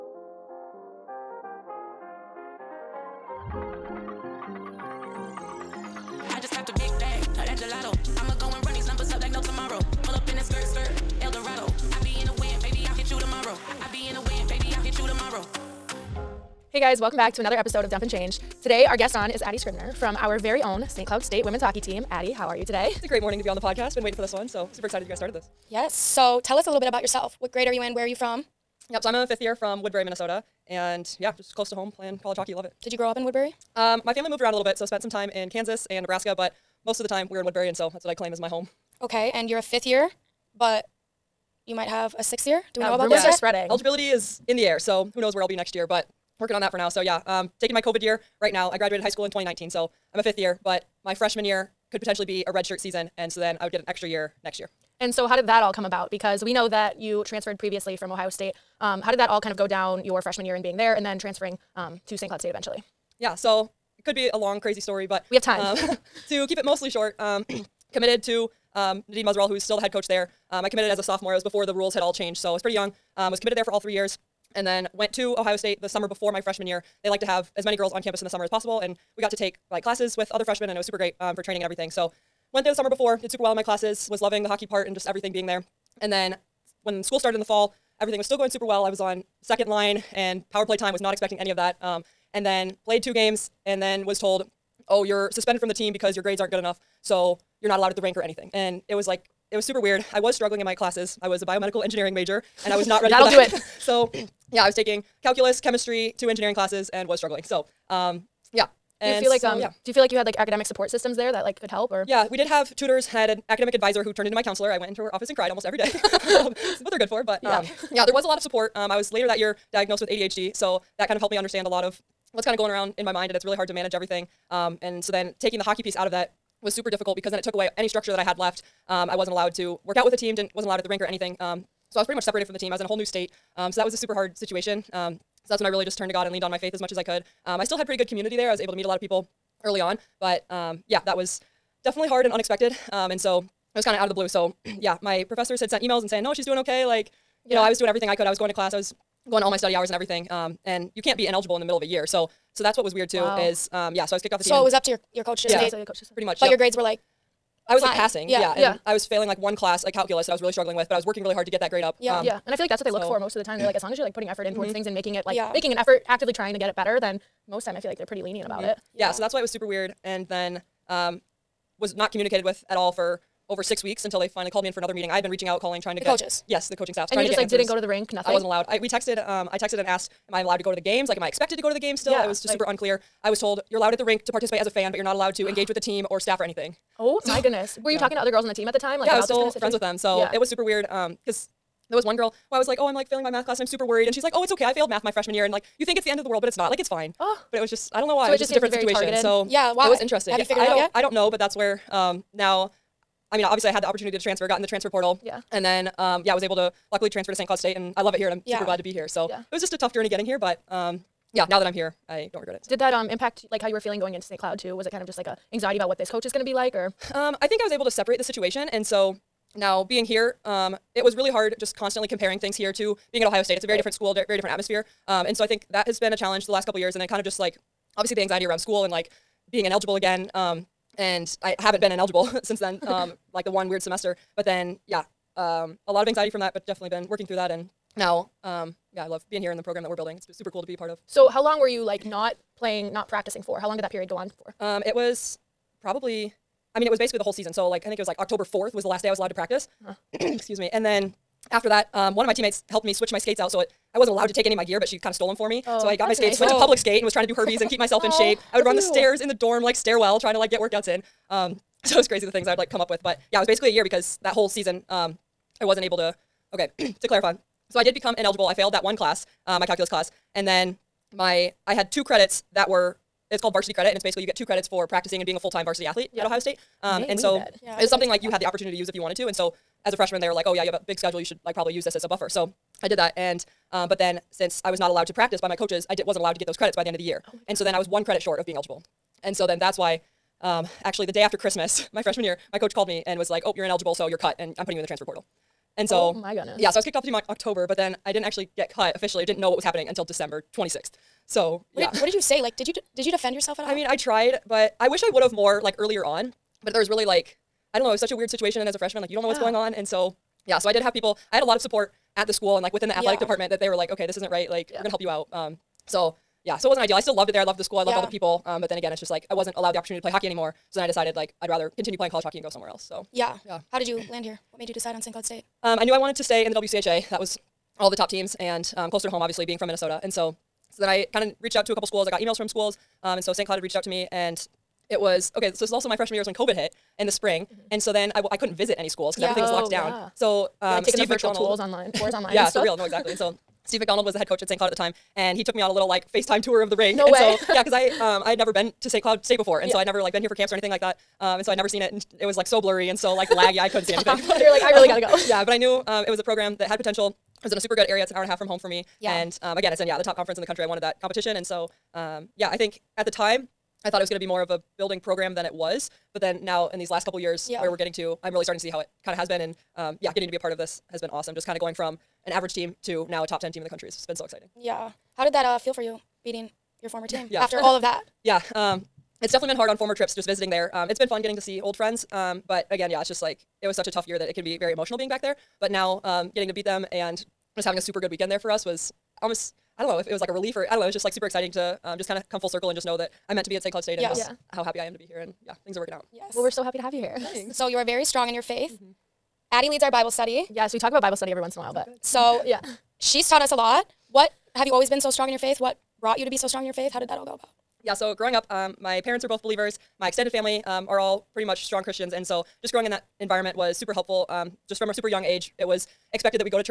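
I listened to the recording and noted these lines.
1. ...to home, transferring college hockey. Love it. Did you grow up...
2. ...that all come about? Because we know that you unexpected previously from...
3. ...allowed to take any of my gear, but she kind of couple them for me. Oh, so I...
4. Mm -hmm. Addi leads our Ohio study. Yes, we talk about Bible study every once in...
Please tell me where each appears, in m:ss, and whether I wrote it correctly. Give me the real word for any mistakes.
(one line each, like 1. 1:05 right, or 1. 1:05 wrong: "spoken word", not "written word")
1. 0:31 wrong: "playing", not "transferring"
2. 0:55 wrong: "transferred", not "unexpected"
3. 4:14 wrong: "stole", not "couple"
4. 6:38 wrong: "Bible", not "Ohio".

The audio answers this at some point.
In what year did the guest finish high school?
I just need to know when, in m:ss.
0:49.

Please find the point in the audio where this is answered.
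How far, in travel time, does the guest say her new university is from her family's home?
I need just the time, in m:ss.
5:58.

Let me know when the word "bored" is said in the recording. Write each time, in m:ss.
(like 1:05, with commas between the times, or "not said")
not said.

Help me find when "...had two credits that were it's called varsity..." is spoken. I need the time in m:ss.
4:31.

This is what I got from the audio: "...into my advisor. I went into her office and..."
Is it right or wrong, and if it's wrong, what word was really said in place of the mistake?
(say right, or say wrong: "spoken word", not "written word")
wrong: "counselor", not "advisor".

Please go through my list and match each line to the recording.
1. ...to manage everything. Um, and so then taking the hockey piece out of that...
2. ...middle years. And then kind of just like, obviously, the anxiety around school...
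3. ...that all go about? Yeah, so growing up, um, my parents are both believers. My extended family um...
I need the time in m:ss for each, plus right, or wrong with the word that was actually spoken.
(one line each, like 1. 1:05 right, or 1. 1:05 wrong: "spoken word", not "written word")
1. 2:03 right
2. 3:46 wrong: "couple", not "middle"
3. 6:47 right.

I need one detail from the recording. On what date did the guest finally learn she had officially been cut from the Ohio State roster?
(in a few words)
December 26th.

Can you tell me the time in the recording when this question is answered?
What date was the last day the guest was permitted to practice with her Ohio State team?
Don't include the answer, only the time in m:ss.
4:08.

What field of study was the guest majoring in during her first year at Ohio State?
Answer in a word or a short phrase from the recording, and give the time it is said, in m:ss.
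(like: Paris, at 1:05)
Biomedical engineering, at 1:41.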